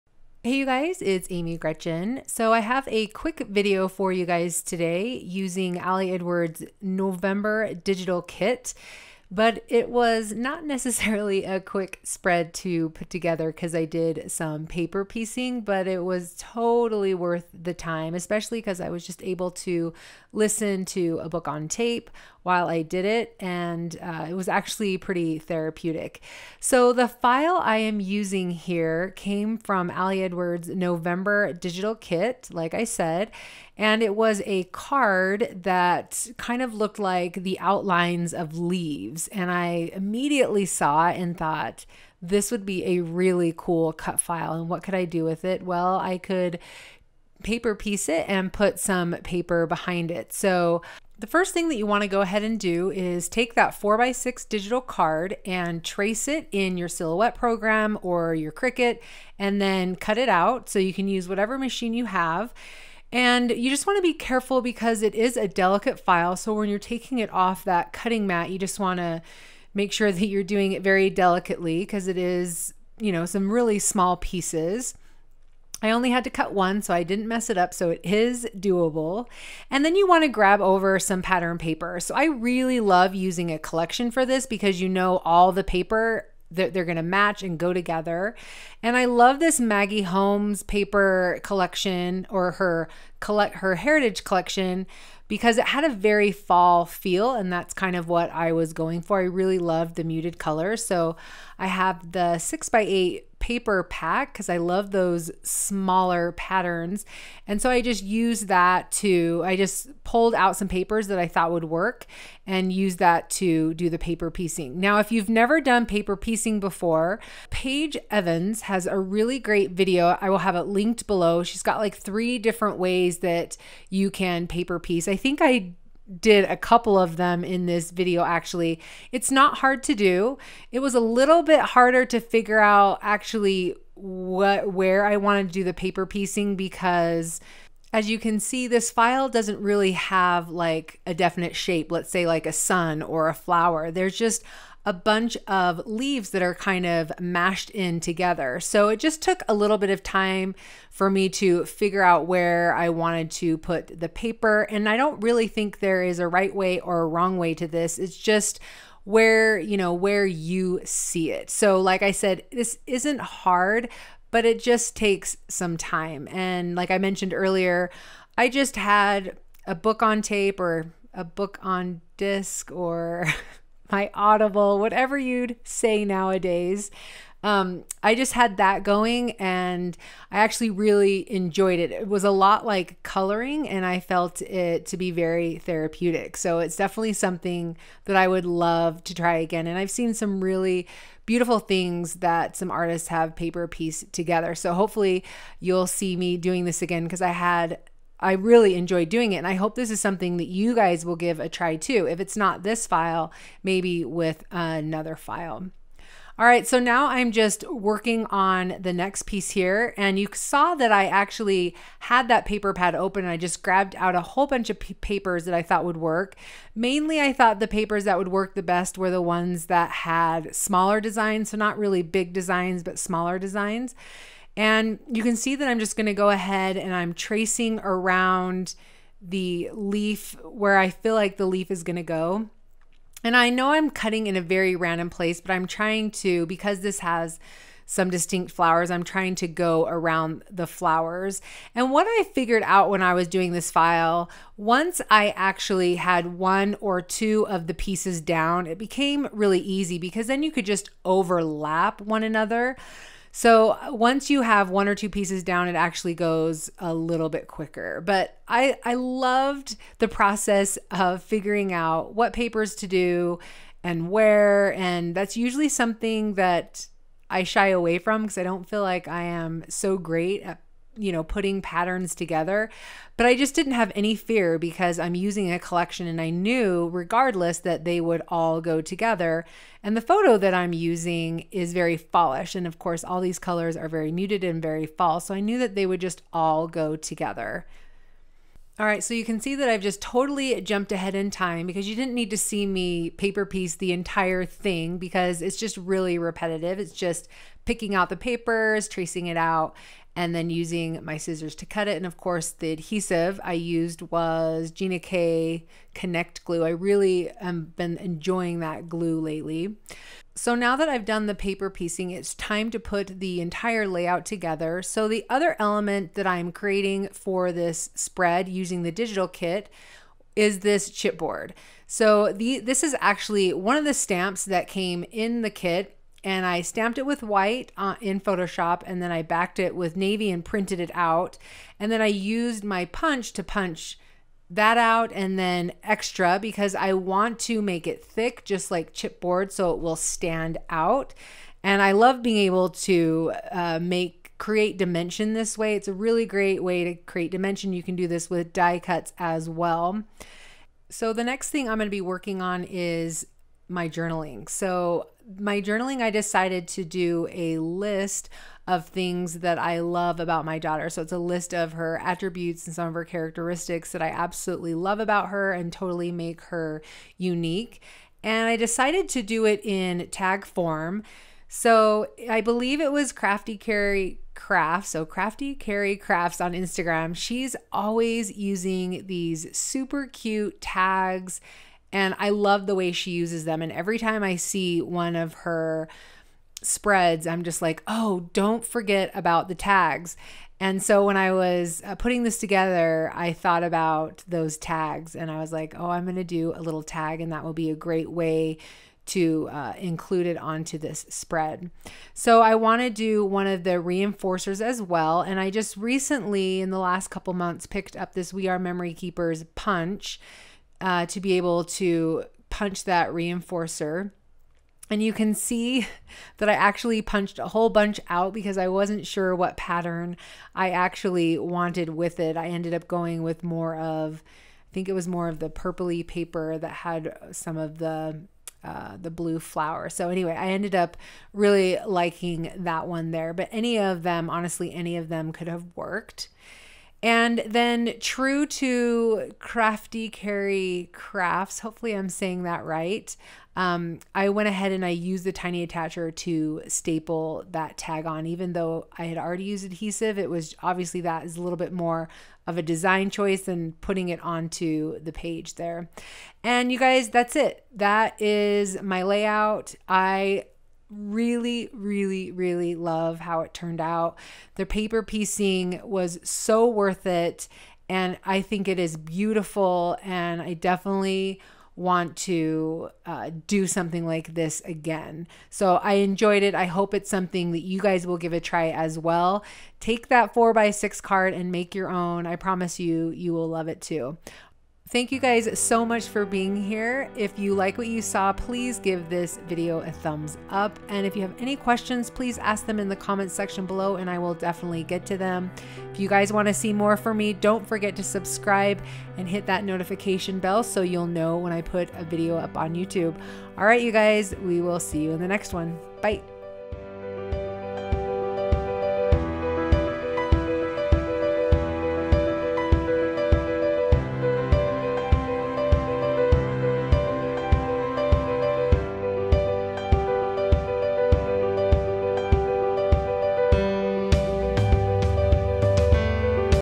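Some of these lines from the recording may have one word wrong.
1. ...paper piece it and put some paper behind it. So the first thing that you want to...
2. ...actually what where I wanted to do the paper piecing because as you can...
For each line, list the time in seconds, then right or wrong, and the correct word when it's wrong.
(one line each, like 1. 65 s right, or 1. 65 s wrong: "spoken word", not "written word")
1. 47 s right
2. 133 s right.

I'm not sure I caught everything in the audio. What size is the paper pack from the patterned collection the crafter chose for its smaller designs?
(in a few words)
6 by 8.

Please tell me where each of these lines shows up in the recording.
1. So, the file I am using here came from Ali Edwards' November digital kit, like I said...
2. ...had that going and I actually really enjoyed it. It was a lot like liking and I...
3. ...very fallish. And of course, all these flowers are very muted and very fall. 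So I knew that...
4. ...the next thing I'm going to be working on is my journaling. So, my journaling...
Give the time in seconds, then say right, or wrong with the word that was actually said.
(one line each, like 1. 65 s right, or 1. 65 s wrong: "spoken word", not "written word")
1. 26 s right
2. 178 s wrong: "coloring", not "liking"
3. 281 s wrong: "colors", not "flowers"
4. 351 s right.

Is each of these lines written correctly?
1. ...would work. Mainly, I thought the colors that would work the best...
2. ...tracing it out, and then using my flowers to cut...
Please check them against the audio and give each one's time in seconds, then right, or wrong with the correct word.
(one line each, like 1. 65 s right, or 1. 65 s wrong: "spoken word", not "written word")
1. 215 s wrong: "papers", not "colors"
2. 298 s wrong: "scissors", not "flowers".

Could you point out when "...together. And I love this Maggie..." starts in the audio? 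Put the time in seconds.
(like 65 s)
87 s.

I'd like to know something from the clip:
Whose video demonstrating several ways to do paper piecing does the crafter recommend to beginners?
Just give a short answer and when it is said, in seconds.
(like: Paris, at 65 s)
Paige Evans, at 117 s.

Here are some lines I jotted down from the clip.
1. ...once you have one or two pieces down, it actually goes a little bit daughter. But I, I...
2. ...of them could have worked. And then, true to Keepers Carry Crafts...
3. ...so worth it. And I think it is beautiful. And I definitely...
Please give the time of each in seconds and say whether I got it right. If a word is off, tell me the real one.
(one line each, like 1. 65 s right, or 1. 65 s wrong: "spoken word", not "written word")
1. 253 s wrong: "quicker", not "daughter"
2. 434 s wrong: "Crafty", not "Keepers"
3. 466 s right.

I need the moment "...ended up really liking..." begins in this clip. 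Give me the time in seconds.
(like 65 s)
430 s.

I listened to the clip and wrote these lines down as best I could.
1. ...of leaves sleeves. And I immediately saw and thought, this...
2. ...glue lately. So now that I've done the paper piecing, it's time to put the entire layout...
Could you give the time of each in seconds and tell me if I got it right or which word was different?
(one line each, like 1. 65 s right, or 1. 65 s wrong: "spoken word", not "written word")
1. 38 s right
2. 308 s right.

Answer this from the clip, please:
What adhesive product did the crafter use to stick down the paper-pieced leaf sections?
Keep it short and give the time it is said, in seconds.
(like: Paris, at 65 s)
Gina K Connect Glue, at 304 s.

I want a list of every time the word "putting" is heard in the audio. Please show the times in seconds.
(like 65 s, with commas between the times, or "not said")
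271 s, 391 s, 453 s.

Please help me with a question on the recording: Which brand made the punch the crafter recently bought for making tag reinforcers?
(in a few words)
We Are Memory Keepers.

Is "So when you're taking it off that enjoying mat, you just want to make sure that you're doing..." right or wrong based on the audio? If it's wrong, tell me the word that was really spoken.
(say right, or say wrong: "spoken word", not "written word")
wrong: "cutting", not "enjoying".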